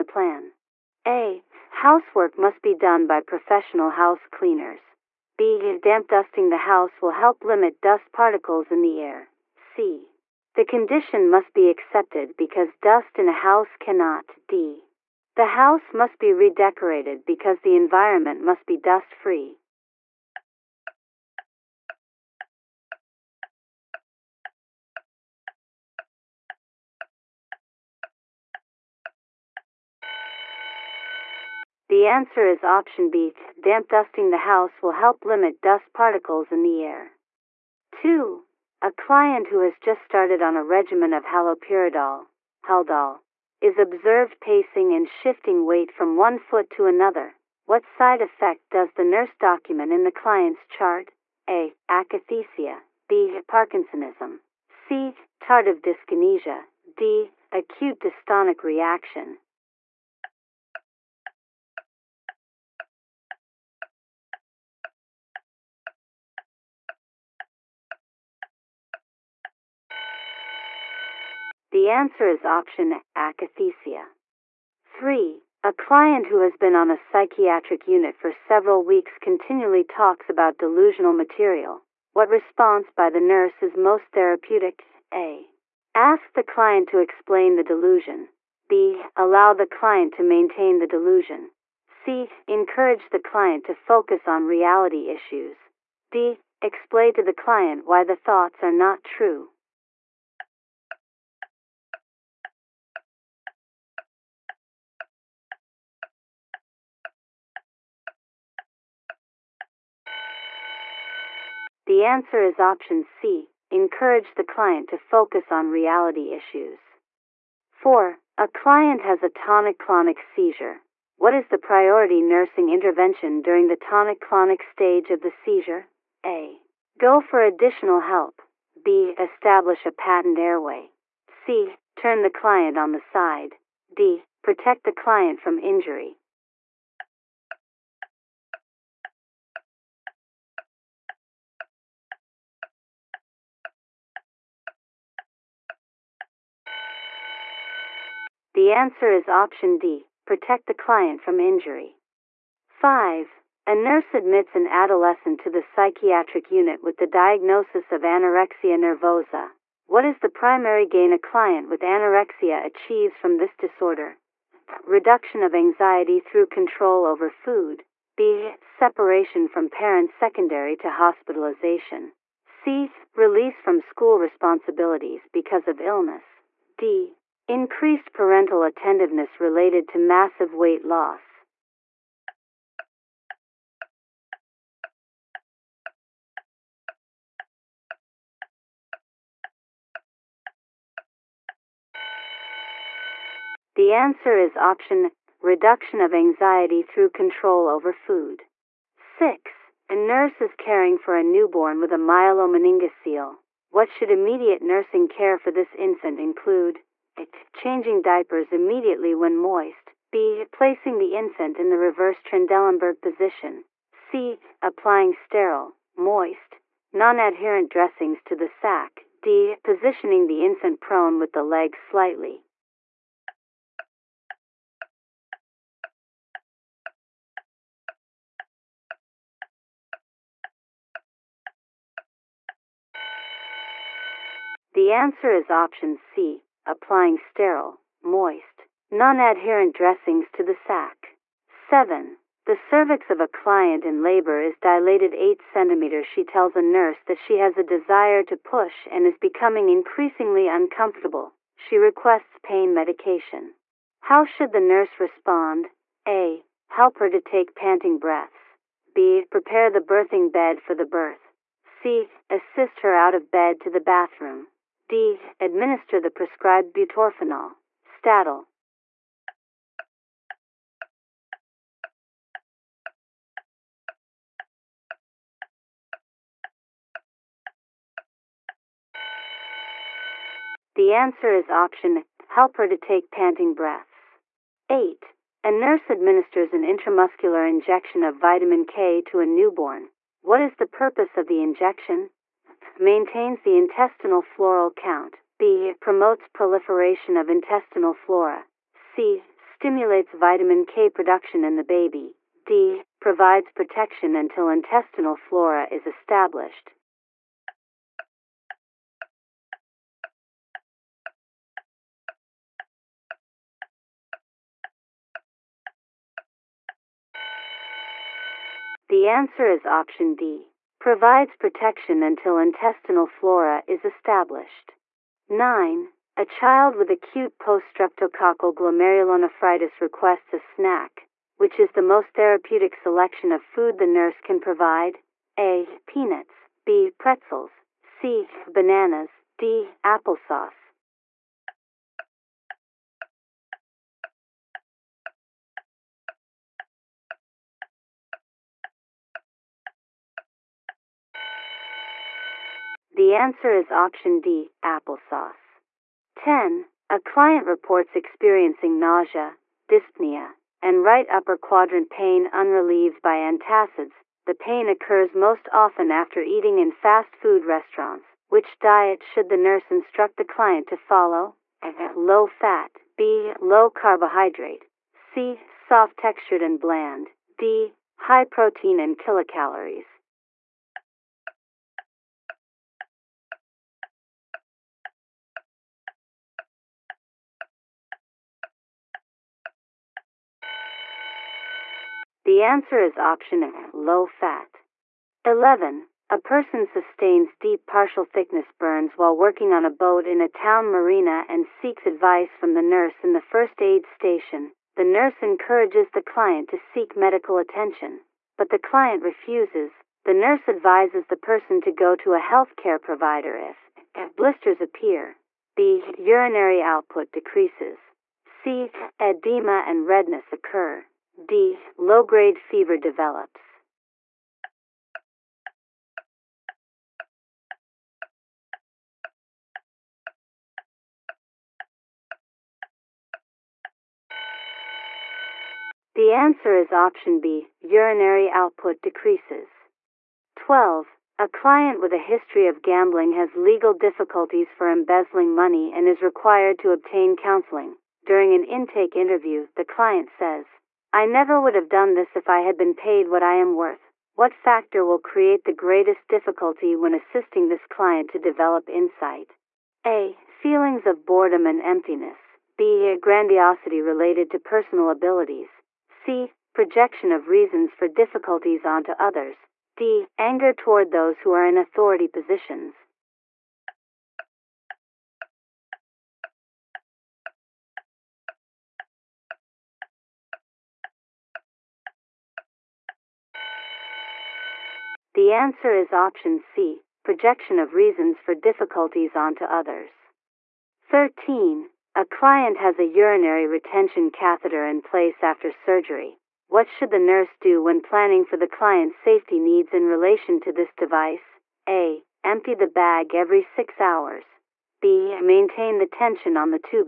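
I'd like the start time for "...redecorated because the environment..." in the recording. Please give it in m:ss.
0:16.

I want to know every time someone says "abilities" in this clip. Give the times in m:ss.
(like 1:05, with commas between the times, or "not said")
7:44.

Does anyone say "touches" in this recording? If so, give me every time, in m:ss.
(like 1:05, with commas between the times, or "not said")
not said.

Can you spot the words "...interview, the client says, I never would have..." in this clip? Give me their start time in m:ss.
7:28.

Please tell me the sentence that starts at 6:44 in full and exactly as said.
The nurse encourages the client to seek medical attention, but the client refuses.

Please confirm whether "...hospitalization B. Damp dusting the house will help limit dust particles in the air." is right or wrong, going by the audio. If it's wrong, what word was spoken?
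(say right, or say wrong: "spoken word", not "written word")
wrong: "option", not "hospitalization".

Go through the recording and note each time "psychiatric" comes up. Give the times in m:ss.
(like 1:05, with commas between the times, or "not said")
1:16, 2:35.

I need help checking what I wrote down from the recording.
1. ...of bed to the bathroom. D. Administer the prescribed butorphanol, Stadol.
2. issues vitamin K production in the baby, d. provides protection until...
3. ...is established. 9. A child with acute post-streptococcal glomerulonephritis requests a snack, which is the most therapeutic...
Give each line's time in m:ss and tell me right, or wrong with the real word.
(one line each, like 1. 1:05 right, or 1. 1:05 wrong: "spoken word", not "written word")
1. 4:23 right
2. 4:59 wrong: "stimulates", not "issues"
3. 5:23 right.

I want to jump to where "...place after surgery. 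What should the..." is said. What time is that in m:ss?
8:14.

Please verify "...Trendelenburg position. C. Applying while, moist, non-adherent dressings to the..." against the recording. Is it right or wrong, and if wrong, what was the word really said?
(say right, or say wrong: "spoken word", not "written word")
wrong: "sterile", not "while".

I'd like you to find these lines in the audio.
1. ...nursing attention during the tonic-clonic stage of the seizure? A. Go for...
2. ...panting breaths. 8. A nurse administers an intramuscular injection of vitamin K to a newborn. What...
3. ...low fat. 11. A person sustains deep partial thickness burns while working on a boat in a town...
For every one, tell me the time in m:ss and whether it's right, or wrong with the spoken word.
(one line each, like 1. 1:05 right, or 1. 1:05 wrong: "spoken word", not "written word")
1. 2:02 wrong: "intervention", not "attention"
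2. 4:43 right
3. 6:33 right.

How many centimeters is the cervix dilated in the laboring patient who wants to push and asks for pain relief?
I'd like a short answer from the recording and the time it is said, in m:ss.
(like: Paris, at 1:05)
8, at 4:05.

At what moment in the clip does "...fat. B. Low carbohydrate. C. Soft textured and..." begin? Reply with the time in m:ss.
6:12.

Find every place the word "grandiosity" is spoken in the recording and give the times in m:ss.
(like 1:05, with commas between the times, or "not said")
7:42.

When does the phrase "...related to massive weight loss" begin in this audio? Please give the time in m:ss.
2:59.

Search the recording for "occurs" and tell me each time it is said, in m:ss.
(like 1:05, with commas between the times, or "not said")
6:04, 7:00.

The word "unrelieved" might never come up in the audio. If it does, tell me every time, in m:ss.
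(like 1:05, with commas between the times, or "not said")
6:02.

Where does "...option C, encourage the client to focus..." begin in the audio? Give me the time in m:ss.
1:52.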